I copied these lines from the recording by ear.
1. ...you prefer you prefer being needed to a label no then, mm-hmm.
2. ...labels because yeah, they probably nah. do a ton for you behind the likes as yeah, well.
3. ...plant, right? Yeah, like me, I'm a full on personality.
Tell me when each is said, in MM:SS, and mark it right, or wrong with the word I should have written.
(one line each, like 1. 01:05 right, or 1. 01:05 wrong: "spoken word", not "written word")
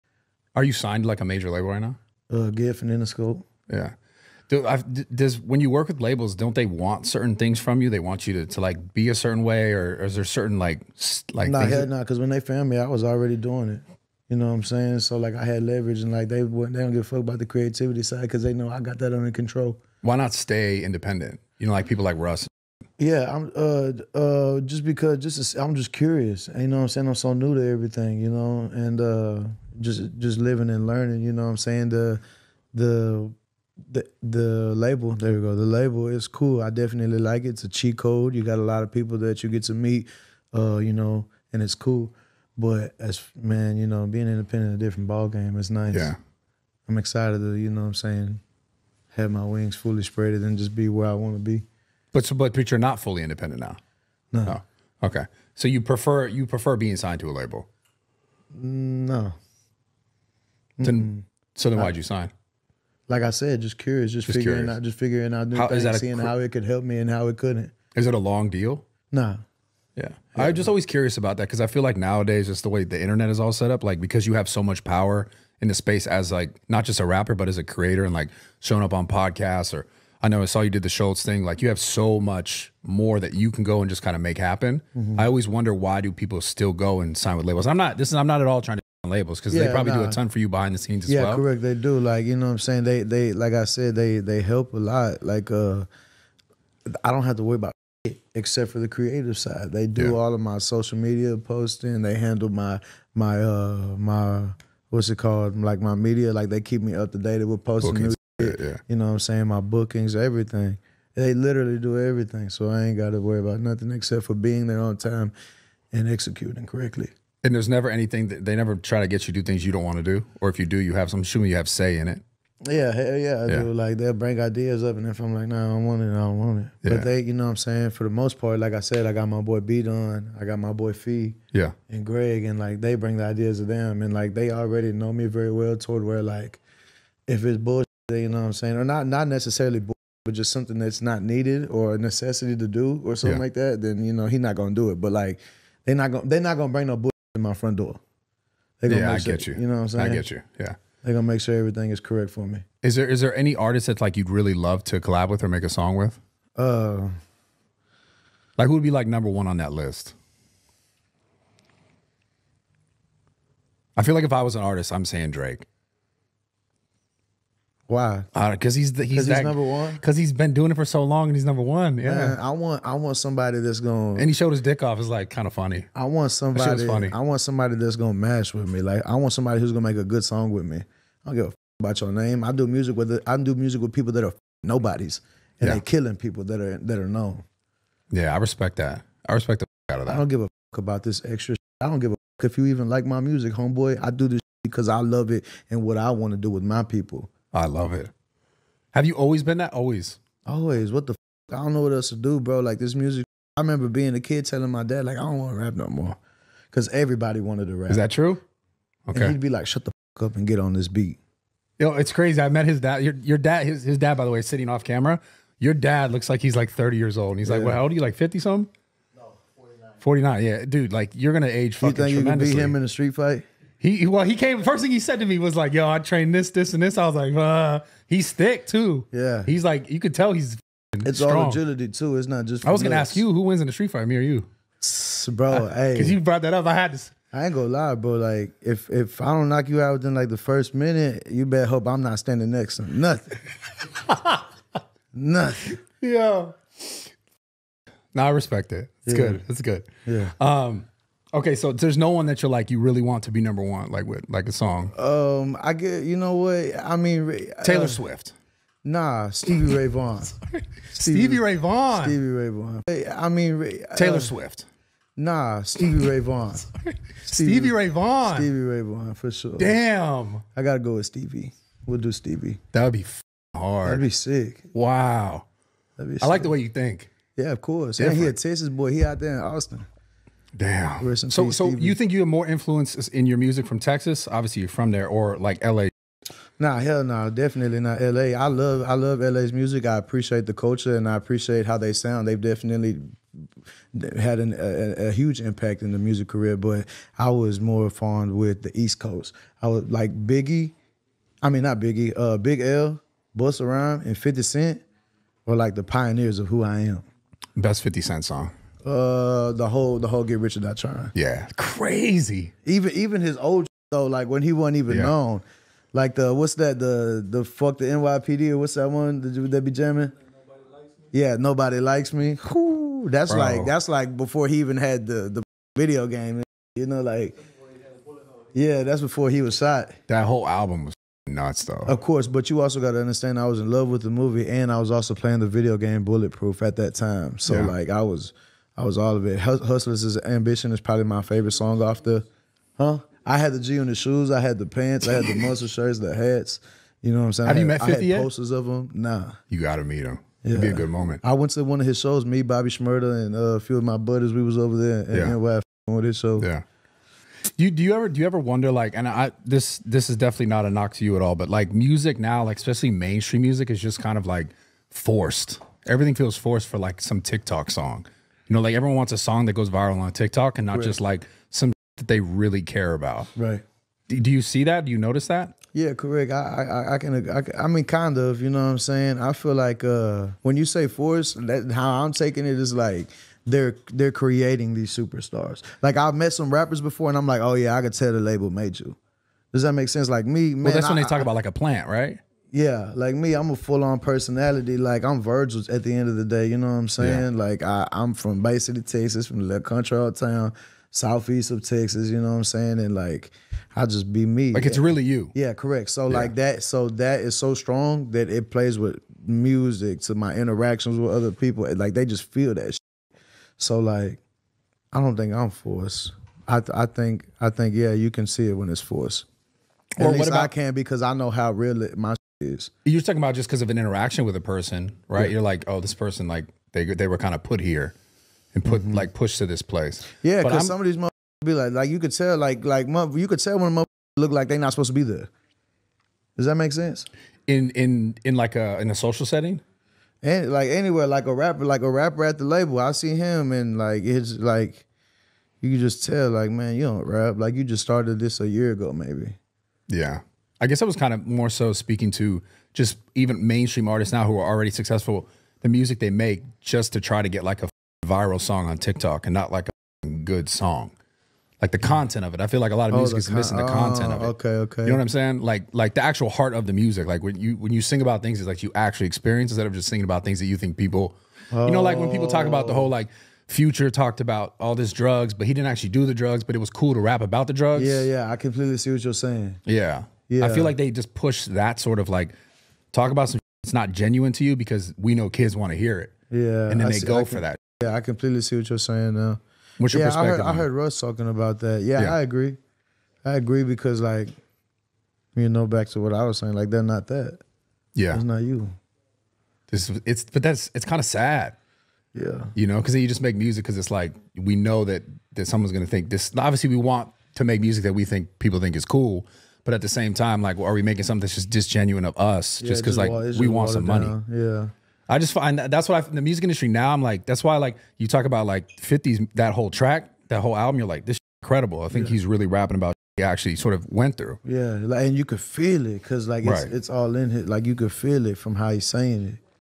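1. 00:55 wrong: "signed", not "needed"
2. 01:29 wrong: "scenes", not "likes"
3. 06:31 right.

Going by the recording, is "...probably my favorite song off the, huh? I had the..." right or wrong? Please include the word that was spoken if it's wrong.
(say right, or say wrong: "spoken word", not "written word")
right.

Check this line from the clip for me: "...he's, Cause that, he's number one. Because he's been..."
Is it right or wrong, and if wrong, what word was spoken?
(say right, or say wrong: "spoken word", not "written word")
right.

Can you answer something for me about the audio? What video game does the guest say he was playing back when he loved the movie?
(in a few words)
Bulletproof.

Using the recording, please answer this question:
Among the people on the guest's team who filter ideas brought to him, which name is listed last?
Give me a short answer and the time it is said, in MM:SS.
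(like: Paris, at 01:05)
Greg, at 02:12.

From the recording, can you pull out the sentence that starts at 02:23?
like that, then you know he's not gonna do it.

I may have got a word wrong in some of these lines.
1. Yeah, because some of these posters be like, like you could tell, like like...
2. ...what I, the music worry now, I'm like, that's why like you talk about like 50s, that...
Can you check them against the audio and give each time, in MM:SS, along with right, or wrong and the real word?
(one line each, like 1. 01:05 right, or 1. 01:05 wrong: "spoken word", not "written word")
1. 07:10 wrong: "motherfuckers", not "posters"
2. 08:35 wrong: "industry", not "worry".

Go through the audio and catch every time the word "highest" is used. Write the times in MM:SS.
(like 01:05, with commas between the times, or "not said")
not said.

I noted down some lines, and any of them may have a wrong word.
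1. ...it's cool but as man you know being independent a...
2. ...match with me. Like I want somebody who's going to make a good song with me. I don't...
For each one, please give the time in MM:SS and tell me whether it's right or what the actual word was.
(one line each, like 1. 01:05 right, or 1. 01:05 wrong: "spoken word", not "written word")
1. 00:41 right
2. 02:58 right.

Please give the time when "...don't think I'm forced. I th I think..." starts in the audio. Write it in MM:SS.
06:54.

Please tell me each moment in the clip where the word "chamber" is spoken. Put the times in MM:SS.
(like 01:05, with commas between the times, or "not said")
not said.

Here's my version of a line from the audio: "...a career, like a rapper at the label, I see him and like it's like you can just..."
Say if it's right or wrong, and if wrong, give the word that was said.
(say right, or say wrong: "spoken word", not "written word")
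wrong: "rapper", not "career".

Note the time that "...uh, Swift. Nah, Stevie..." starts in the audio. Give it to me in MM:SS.
04:17.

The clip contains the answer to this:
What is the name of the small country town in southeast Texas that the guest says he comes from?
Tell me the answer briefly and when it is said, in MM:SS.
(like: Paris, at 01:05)
Bay City, at 06:38.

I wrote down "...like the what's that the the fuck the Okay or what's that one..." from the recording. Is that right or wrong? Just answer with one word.
wrong.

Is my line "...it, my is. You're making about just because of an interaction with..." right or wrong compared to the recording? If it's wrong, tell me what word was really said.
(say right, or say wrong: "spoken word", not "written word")
wrong: "talking", not "making".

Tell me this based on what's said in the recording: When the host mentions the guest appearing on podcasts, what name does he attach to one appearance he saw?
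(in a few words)
Schultz.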